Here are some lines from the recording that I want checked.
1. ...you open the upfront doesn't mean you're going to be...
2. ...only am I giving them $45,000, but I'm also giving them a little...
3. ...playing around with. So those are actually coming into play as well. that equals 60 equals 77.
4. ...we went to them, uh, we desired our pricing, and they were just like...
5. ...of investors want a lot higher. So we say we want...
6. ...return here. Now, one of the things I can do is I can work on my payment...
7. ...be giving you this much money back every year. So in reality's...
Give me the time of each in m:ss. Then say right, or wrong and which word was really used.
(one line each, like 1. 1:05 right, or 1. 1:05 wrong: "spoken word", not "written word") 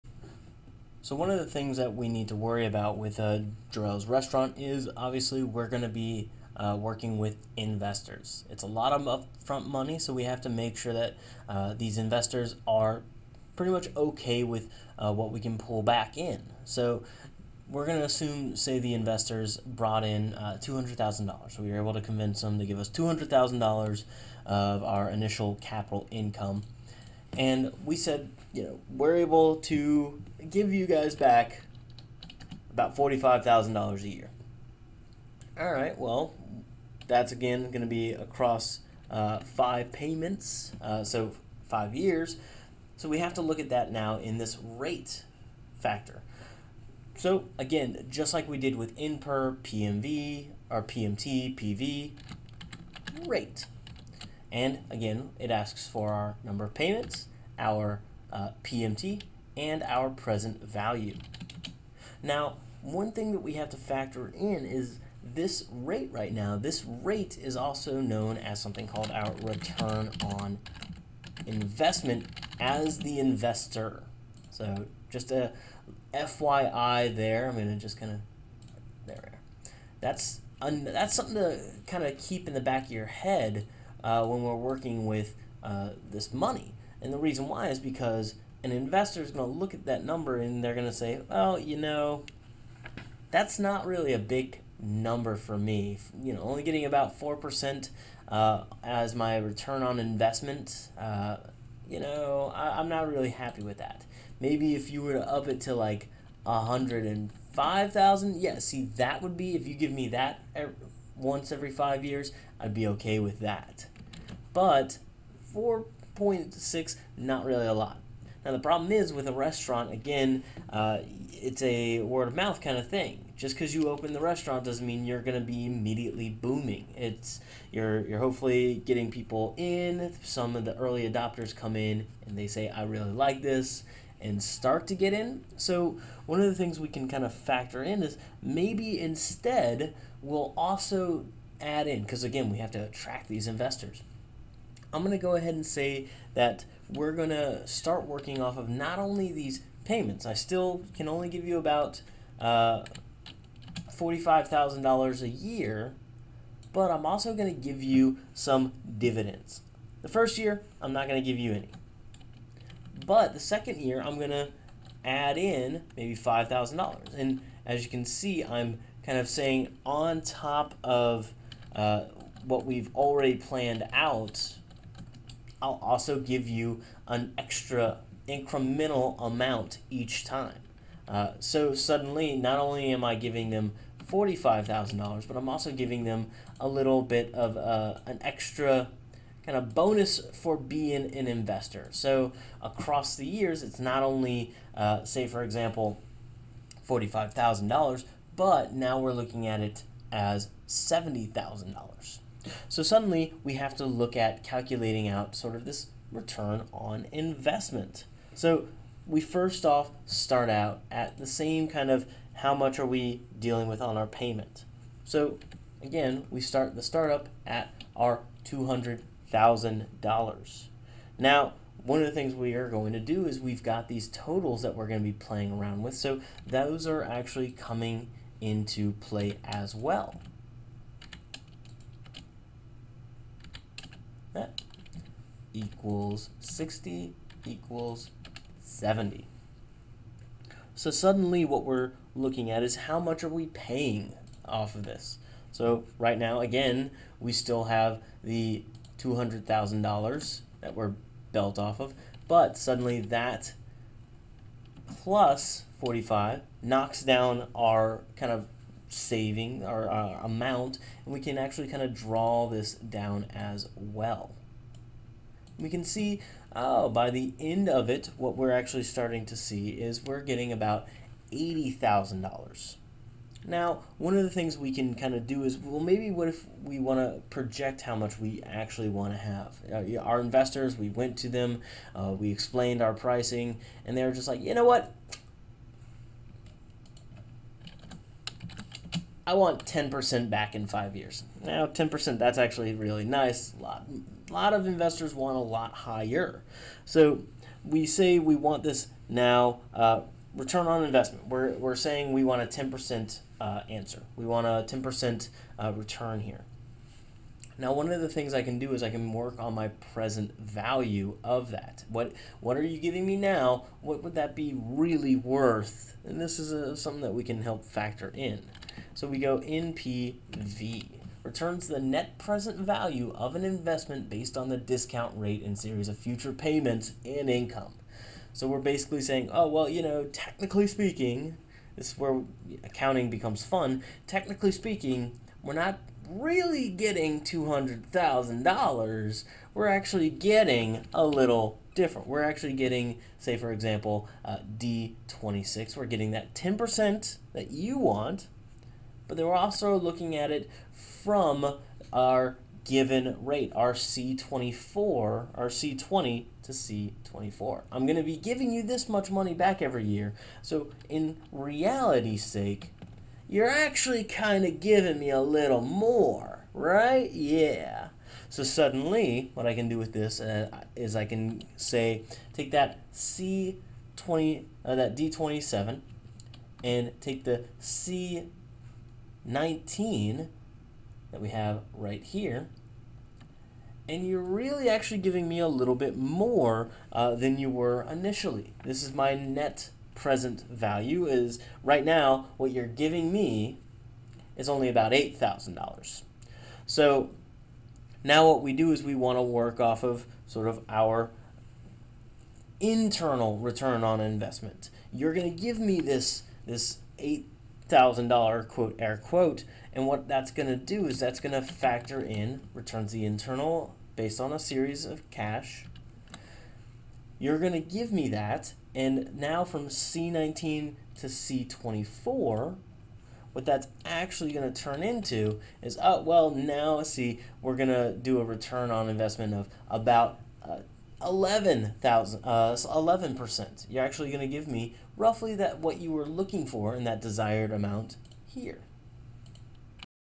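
1. 2:03 wrong: "restaurant", not "upfront"
2. 3:02 right
3. 3:45 wrong: "70", not "77"
4. 4:40 wrong: "explained", not "desired"
5. 4:54 right
6. 5:05 wrong: "present", not "payment"
7. 5:58 right.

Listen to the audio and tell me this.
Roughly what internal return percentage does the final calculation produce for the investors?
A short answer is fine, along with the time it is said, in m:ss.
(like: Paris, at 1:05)
11%, at 7:12.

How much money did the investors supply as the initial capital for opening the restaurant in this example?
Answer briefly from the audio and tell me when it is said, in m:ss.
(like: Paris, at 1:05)
$200,000, at 0:20.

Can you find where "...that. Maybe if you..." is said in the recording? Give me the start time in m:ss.
1:43.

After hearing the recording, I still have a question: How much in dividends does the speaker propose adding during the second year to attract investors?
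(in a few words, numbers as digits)
$5,000.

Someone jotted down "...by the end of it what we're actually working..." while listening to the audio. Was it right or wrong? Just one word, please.
wrong.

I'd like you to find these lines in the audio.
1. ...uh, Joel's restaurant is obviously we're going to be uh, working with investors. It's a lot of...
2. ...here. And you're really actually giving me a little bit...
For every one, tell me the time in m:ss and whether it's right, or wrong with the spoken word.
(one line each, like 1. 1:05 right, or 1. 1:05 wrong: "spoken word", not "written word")
1. 0:03 right
2. 6:22 right.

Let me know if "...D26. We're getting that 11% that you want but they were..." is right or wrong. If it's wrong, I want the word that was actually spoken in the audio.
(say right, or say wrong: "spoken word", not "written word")
wrong: "10", not "11".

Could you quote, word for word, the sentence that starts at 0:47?
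So again, just like we did with per PMV, or PMT, PV, rate.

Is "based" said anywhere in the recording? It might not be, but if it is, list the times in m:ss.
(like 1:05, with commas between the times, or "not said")
5:24, 6:53.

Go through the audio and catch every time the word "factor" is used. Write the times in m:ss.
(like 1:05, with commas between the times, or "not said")
0:45, 1:03, 2:17, 5:17, 6:51.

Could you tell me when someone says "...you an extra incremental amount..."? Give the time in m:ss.
2:56.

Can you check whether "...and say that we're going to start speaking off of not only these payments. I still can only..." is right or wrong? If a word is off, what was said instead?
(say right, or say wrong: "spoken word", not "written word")
wrong: "working", not "speaking".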